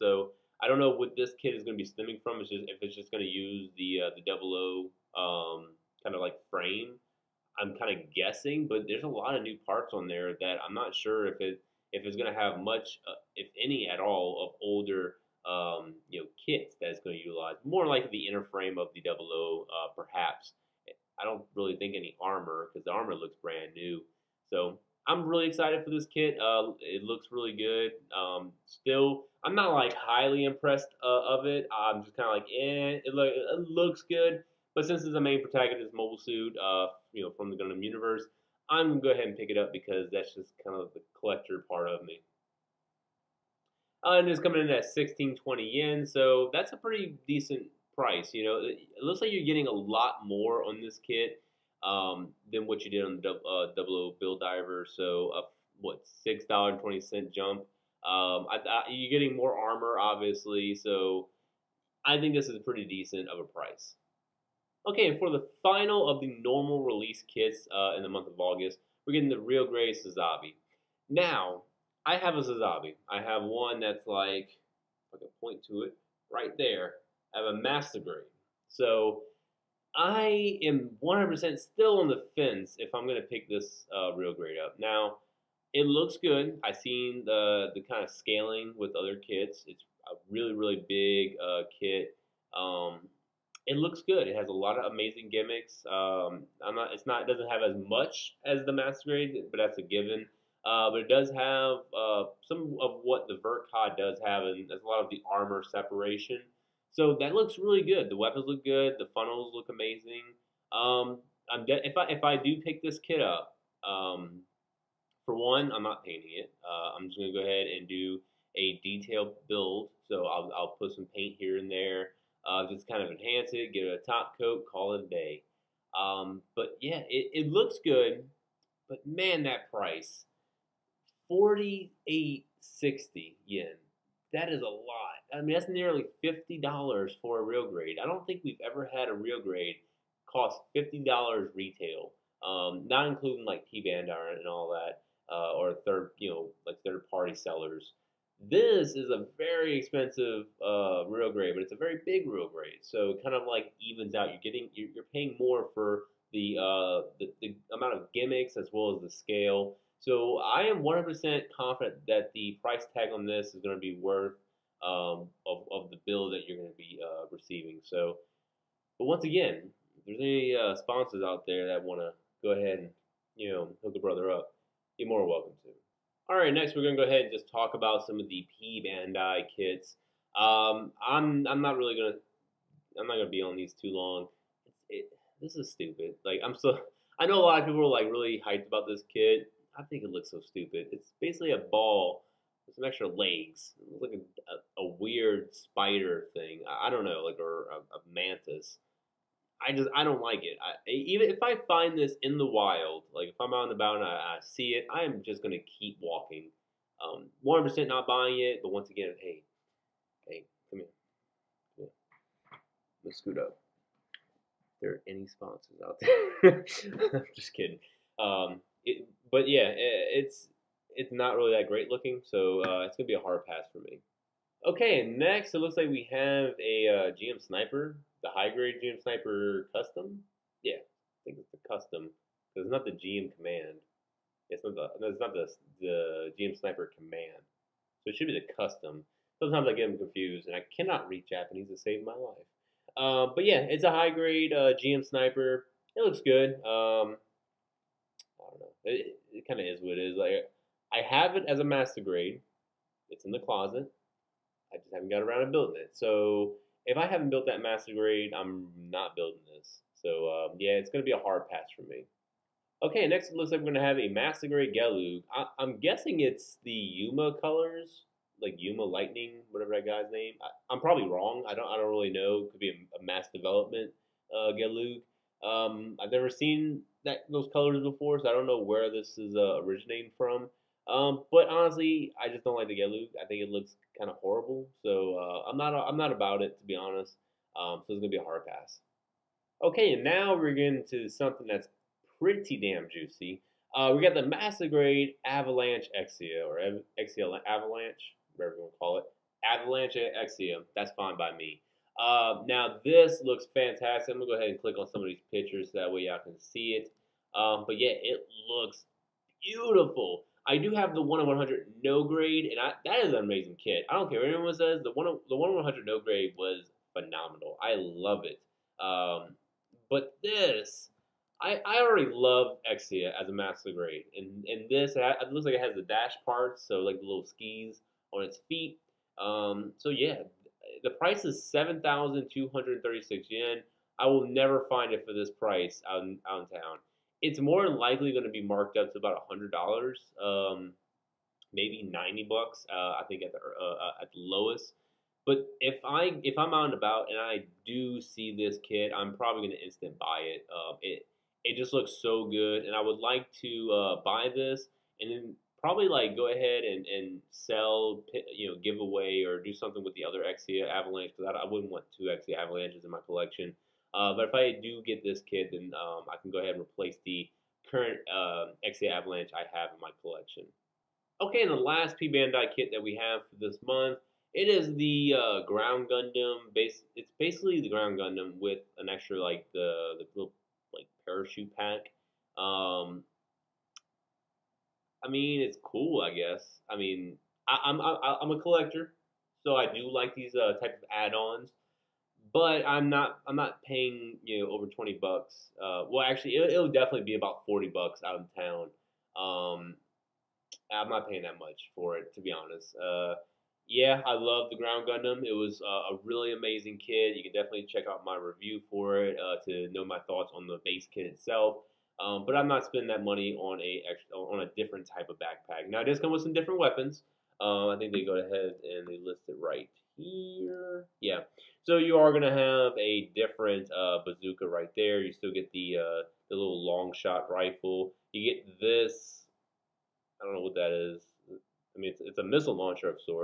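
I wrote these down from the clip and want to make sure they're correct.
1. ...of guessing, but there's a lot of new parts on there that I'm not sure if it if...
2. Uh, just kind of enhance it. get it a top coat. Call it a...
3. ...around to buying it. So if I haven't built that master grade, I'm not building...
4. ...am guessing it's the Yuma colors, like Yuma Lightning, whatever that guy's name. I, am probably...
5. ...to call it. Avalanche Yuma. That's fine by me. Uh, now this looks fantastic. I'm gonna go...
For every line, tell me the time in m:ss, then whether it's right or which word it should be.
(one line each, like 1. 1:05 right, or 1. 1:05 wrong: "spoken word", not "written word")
1. 0:07 right
2. 2:02 right
3. 4:15 wrong: "building", not "buying"
4. 4:25 right
5. 4:58 wrong: "Exia", not "Yuma".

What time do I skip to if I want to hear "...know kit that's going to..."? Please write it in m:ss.
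0:16.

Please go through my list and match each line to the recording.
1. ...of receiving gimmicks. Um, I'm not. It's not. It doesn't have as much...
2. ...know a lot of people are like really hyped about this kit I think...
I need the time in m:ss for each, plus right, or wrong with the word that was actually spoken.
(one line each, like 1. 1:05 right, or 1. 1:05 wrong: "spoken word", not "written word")
1. 1:34 wrong: "amazing", not "receiving"
2. 3:07 right.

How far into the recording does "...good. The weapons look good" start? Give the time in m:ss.
1:47.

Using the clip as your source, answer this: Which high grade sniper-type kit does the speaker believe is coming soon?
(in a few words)
GM Sniper Custom.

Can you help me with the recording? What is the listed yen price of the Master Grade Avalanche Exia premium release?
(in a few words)
7,236 yen.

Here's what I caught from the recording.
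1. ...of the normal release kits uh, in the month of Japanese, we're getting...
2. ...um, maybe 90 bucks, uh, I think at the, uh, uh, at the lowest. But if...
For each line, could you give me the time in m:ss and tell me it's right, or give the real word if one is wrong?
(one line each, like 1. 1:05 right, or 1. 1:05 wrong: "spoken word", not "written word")
1. 1:06 wrong: "August", not "Japanese"
2. 5:40 right.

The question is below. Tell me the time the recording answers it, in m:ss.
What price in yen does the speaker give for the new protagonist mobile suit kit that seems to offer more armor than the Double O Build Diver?
0:44.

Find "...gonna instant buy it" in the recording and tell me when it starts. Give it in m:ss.
5:49.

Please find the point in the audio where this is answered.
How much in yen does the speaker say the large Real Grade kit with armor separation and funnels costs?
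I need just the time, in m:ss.
2:11.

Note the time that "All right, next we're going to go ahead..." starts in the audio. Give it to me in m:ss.
2:56.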